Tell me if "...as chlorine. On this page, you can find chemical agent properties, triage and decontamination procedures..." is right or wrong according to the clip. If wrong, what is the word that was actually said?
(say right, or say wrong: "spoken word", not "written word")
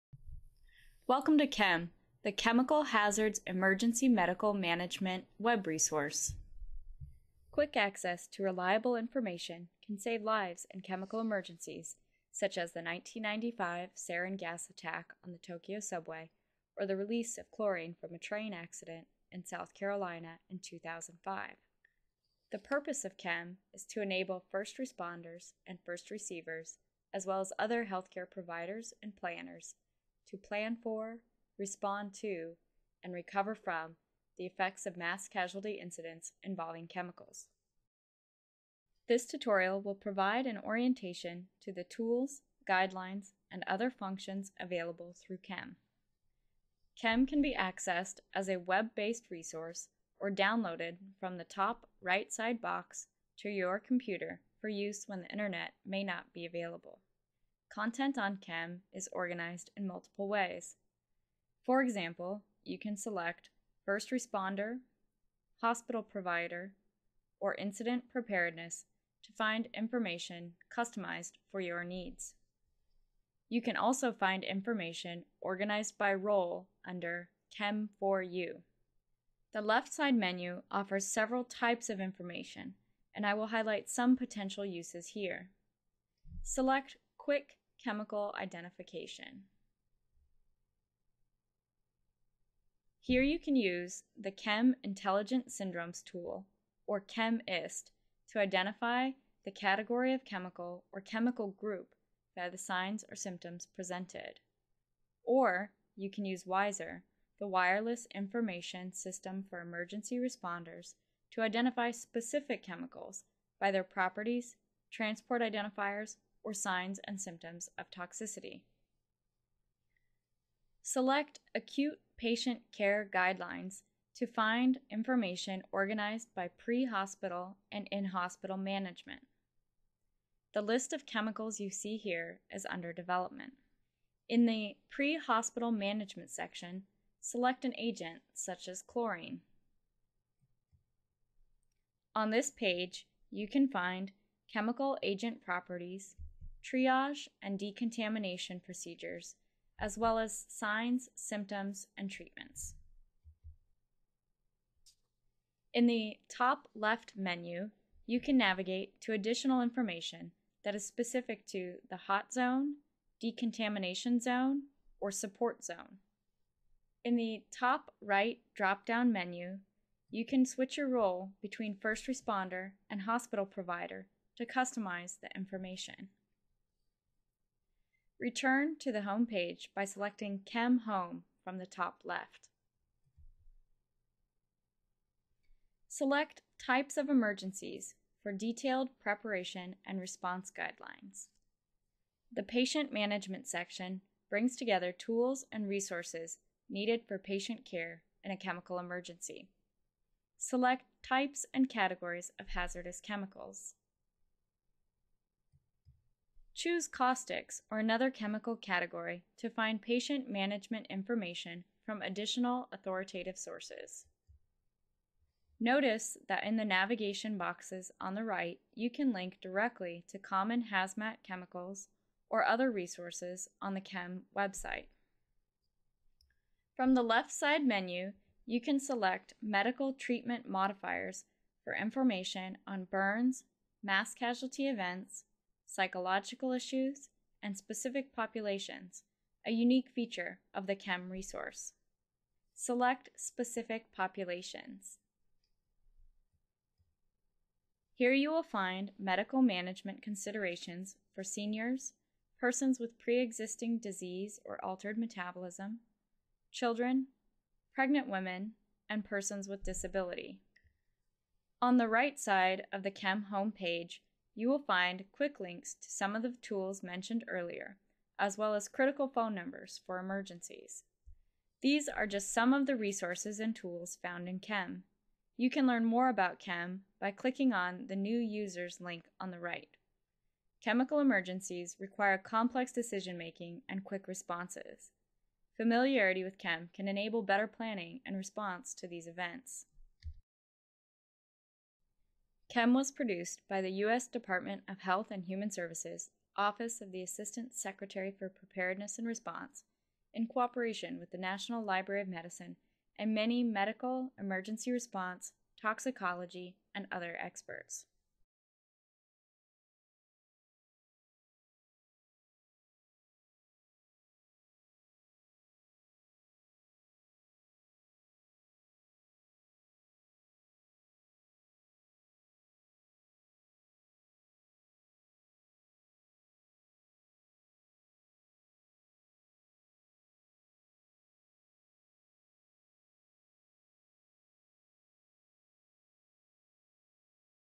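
right.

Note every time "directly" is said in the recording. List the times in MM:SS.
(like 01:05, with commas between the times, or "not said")
03:39.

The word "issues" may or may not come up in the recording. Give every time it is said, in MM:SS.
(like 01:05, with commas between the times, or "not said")
03:56.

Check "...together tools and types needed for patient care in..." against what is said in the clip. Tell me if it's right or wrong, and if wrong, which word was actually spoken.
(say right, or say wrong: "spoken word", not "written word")
wrong: "resources", not "types".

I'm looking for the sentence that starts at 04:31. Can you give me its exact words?
These are just some of the resources and tools found in CHEMM.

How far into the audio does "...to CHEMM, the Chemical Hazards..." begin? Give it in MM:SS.
00:01.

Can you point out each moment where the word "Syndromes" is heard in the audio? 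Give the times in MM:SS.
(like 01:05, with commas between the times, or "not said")
01:35.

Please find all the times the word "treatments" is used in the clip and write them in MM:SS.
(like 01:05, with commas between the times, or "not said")
02:32, 03:49.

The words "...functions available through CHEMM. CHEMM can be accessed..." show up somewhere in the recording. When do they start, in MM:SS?
00:43.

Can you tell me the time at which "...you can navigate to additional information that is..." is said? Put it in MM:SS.
02:38.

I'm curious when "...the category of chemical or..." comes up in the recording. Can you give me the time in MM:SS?
01:39.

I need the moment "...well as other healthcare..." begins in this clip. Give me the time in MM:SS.
00:27.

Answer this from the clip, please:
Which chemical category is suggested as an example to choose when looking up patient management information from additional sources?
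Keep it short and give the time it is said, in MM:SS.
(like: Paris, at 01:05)
caustics, at 03:26.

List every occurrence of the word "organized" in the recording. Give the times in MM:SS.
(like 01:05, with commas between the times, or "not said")
00:59, 01:15, 02:05.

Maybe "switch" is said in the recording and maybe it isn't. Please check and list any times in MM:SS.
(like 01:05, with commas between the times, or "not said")
02:50.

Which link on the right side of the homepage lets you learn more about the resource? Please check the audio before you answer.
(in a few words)
New Users.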